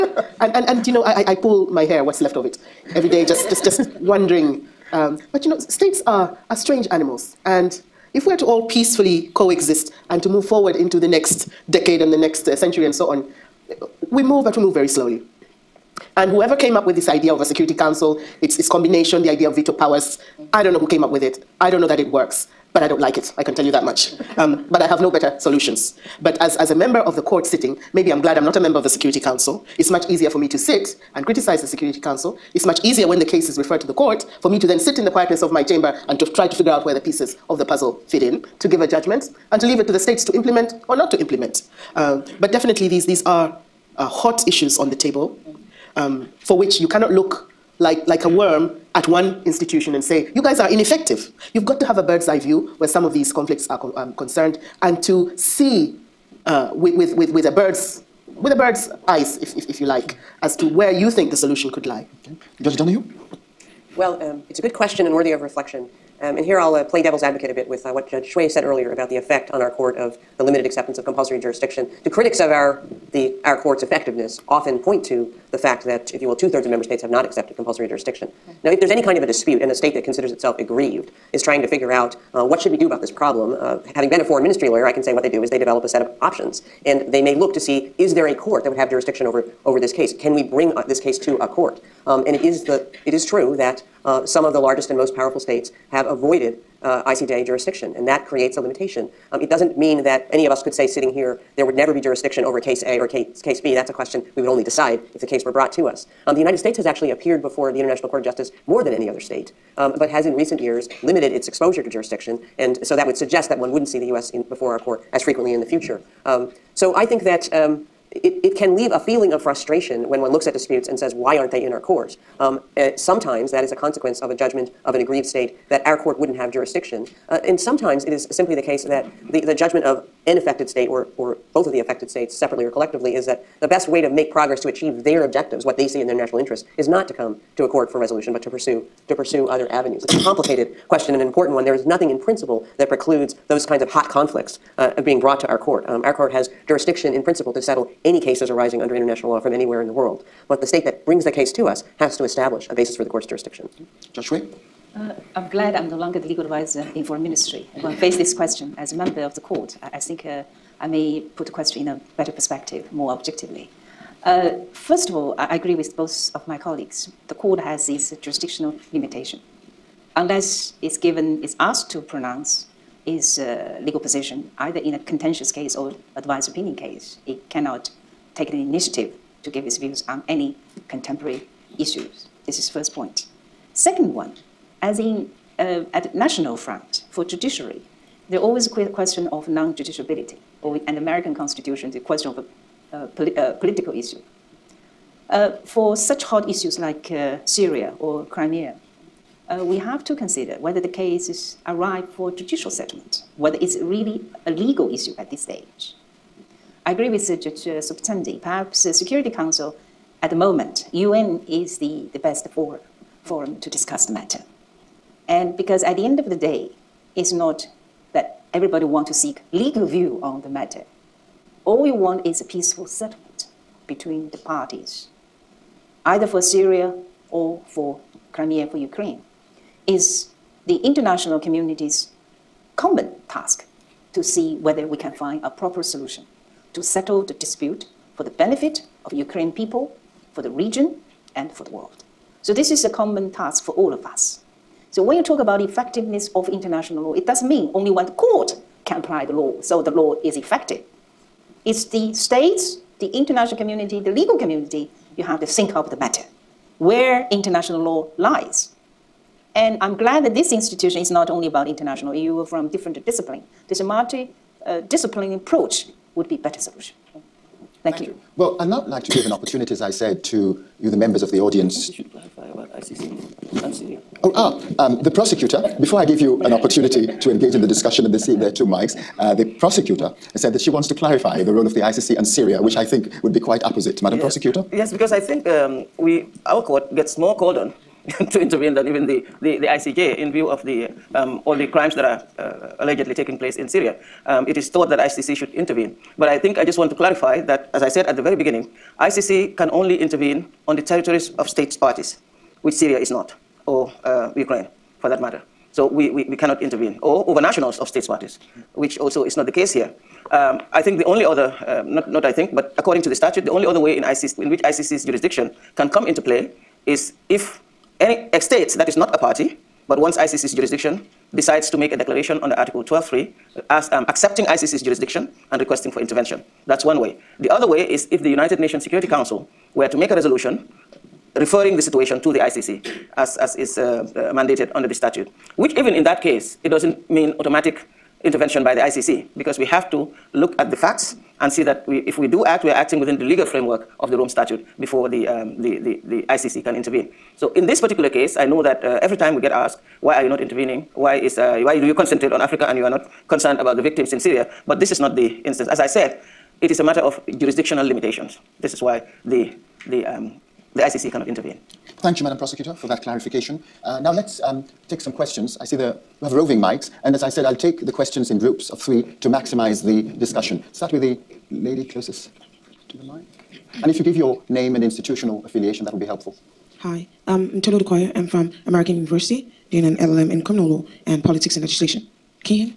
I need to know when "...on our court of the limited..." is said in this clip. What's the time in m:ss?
1:09.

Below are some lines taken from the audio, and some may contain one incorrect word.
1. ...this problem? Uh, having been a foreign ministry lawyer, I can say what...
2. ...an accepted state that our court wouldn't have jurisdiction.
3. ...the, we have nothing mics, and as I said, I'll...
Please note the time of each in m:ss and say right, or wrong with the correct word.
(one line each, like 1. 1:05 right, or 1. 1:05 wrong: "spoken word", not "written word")
1. 1:23 right
2. 2:04 wrong: "aggrieved", not "accepted"
3. 6:05 wrong: "roving", not "nothing".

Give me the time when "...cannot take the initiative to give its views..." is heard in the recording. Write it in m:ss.
2:57.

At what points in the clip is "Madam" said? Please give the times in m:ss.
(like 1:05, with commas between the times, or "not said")
4:44, 6:02.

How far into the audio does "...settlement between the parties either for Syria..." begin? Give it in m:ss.
3:42.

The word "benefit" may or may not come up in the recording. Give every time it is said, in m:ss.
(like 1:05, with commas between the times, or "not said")
3:58.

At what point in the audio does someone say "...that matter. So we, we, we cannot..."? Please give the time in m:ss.
5:05.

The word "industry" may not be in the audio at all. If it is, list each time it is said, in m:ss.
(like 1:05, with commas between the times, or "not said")
not said.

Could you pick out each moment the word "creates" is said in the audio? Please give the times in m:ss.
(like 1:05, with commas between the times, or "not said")
1:38.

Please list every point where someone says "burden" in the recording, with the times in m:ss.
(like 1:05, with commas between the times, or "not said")
not said.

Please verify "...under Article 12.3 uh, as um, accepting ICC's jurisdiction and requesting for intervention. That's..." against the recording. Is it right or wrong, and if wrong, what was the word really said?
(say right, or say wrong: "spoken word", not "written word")
right.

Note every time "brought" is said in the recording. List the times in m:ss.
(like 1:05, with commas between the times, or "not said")
1:45, 2:25.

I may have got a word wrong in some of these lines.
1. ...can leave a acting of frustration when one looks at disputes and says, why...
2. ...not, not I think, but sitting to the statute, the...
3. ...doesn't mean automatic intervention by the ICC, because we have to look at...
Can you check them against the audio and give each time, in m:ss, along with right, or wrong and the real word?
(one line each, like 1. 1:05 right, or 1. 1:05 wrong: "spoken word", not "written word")
1. 1:58 wrong: "feeling", not "acting"
2. 5:11 wrong: "according", not "sitting"
3. 5:36 right.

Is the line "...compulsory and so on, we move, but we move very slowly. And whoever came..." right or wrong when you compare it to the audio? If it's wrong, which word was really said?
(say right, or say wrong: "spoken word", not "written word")
wrong: "century", not "compulsory".